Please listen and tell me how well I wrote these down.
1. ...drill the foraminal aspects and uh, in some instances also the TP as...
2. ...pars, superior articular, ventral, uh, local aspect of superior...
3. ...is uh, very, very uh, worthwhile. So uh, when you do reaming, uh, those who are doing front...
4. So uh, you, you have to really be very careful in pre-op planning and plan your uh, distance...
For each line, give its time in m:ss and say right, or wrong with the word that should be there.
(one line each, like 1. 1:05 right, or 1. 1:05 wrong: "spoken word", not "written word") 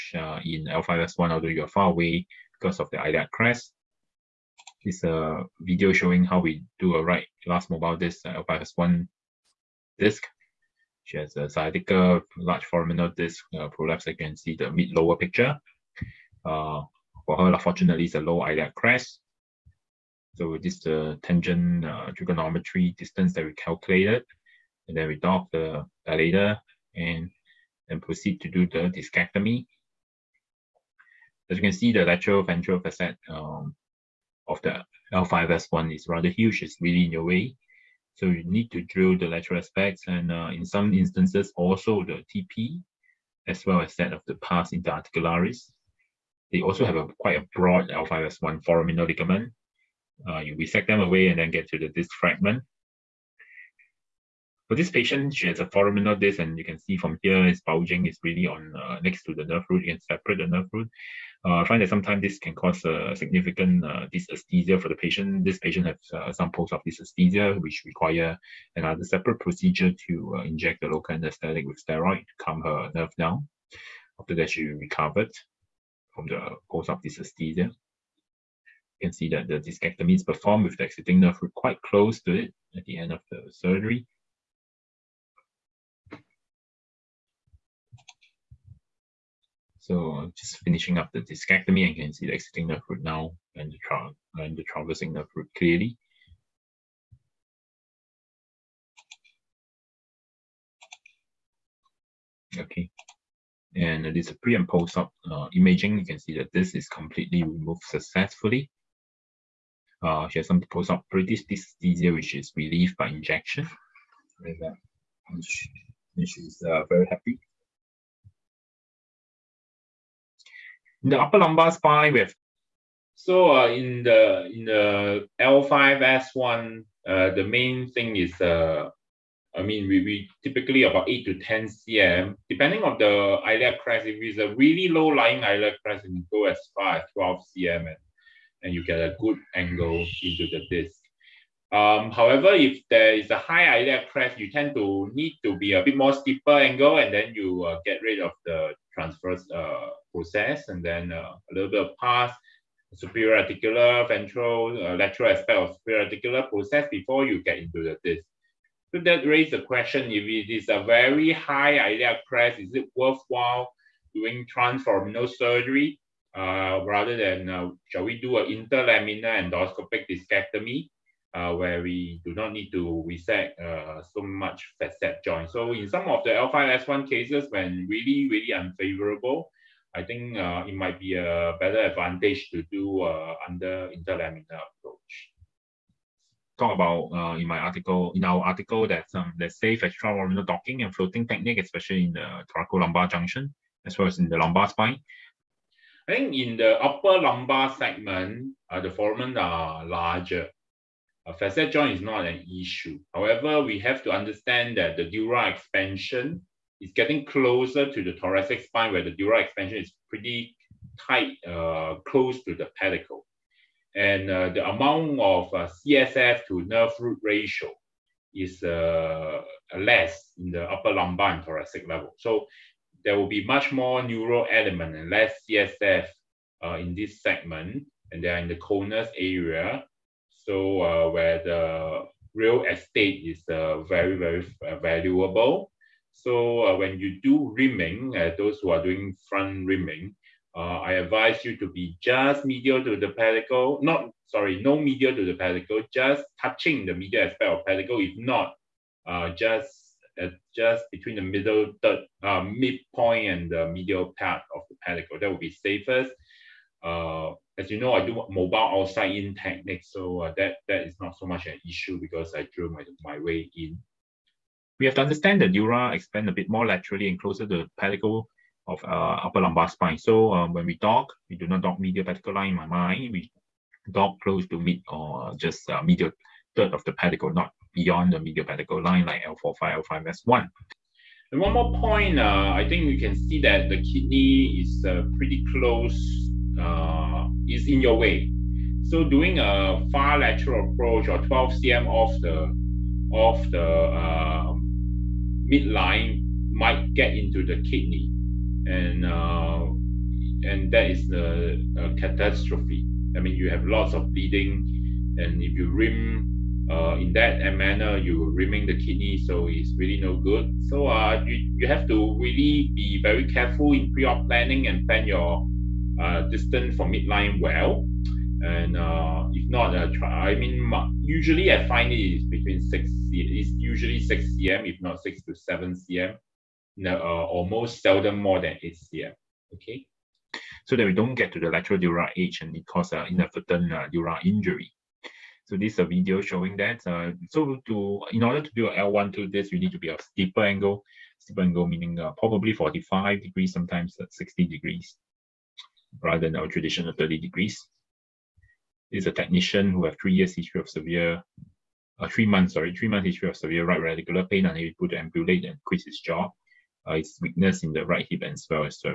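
1. 0:38 wrong: "lateral", not "foraminal"
2. 2:31 wrong: "lateral", not "local"
3. 3:53 wrong: "valuable", not "worthwhile"
4. 5:10 right.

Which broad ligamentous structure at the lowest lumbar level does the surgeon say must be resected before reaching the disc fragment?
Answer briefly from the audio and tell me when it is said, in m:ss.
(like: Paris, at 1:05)
L5S1 foraminal ligament, at 0:47.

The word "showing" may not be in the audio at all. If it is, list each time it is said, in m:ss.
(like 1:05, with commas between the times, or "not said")
0:05, 5:36.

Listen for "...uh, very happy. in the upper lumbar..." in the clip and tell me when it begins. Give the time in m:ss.
1:56.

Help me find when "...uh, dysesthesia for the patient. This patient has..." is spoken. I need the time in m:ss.
1:03.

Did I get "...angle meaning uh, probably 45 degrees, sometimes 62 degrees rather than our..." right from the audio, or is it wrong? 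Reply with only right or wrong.
wrong.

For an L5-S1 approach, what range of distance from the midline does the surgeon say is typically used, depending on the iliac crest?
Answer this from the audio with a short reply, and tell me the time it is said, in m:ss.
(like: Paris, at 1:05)
8 to 10 cm, at 2:11.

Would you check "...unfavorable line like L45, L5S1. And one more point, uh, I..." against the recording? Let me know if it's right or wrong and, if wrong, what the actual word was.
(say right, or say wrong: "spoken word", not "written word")
wrong: "pedicle", not "unfavorable".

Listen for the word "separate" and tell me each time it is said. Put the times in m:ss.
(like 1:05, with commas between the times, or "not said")
1:00, 1:09.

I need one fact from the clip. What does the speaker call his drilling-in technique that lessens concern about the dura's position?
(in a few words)
outside in technique.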